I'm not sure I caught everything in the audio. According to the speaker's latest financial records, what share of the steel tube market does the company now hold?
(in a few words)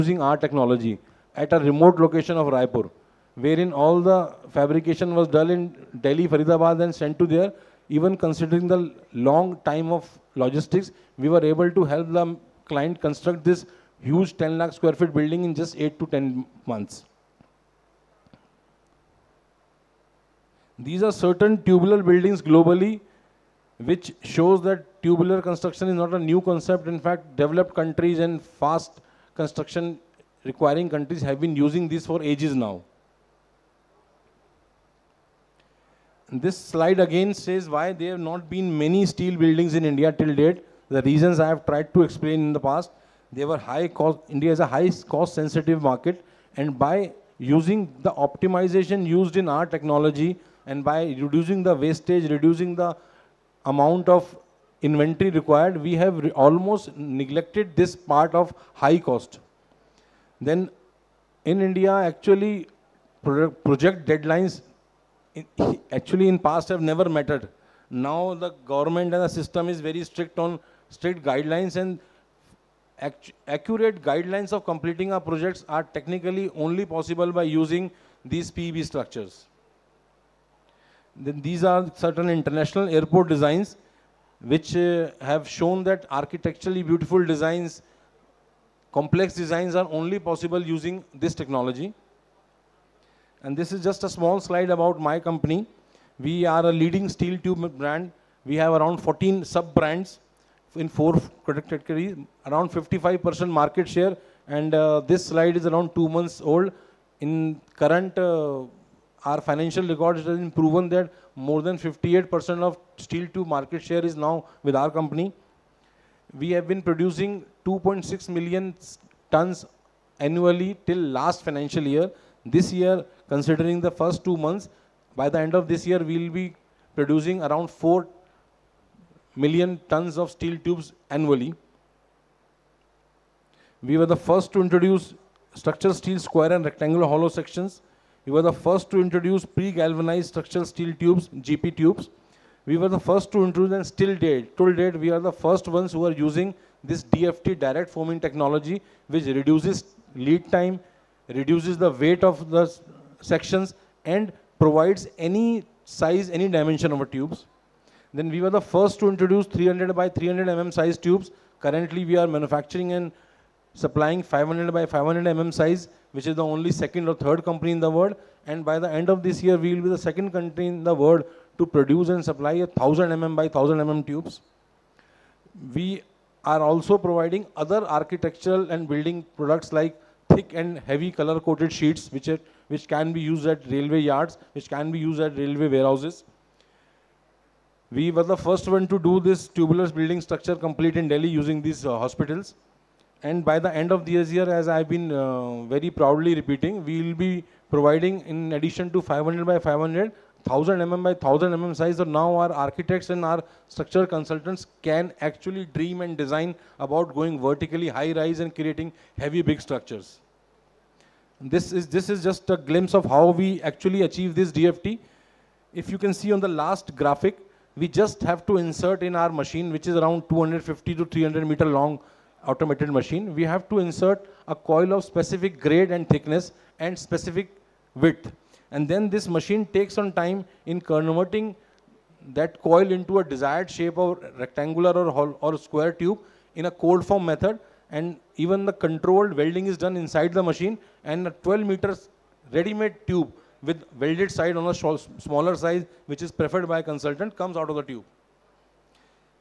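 more than 58%.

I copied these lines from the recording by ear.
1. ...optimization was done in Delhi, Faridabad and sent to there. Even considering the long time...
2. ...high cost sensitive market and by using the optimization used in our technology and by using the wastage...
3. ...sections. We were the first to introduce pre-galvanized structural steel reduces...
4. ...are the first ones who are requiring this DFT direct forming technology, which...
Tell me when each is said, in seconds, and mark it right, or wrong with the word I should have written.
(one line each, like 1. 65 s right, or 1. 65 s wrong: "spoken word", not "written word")
1. 4 s wrong: "fabrication", not "optimization"
2. 44 s wrong: "reducing", not "using"
3. 137 s wrong: "tubes", not "reduces"
4. 145 s wrong: "using", not "requiring".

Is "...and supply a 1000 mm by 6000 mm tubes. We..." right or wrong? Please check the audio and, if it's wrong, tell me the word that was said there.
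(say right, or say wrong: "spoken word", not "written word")
wrong: "1000", not "6000".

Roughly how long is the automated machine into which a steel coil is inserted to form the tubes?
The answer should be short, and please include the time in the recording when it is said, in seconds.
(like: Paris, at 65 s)
250 to 300 meters, at 220 s.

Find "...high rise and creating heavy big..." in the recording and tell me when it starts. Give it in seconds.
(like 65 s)
207 s.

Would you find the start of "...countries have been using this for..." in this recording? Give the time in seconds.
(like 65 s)
30 s.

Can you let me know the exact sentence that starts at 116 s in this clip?
We have been producing 2.6 million tons annually till last financial year.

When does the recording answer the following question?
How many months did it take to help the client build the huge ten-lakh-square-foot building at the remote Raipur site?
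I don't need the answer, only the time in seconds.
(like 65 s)
15 s.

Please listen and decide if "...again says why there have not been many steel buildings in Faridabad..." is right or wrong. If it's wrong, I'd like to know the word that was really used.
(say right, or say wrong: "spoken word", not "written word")
wrong: "India", not "Faridabad".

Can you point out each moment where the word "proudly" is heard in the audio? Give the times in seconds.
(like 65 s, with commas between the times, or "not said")
195 s.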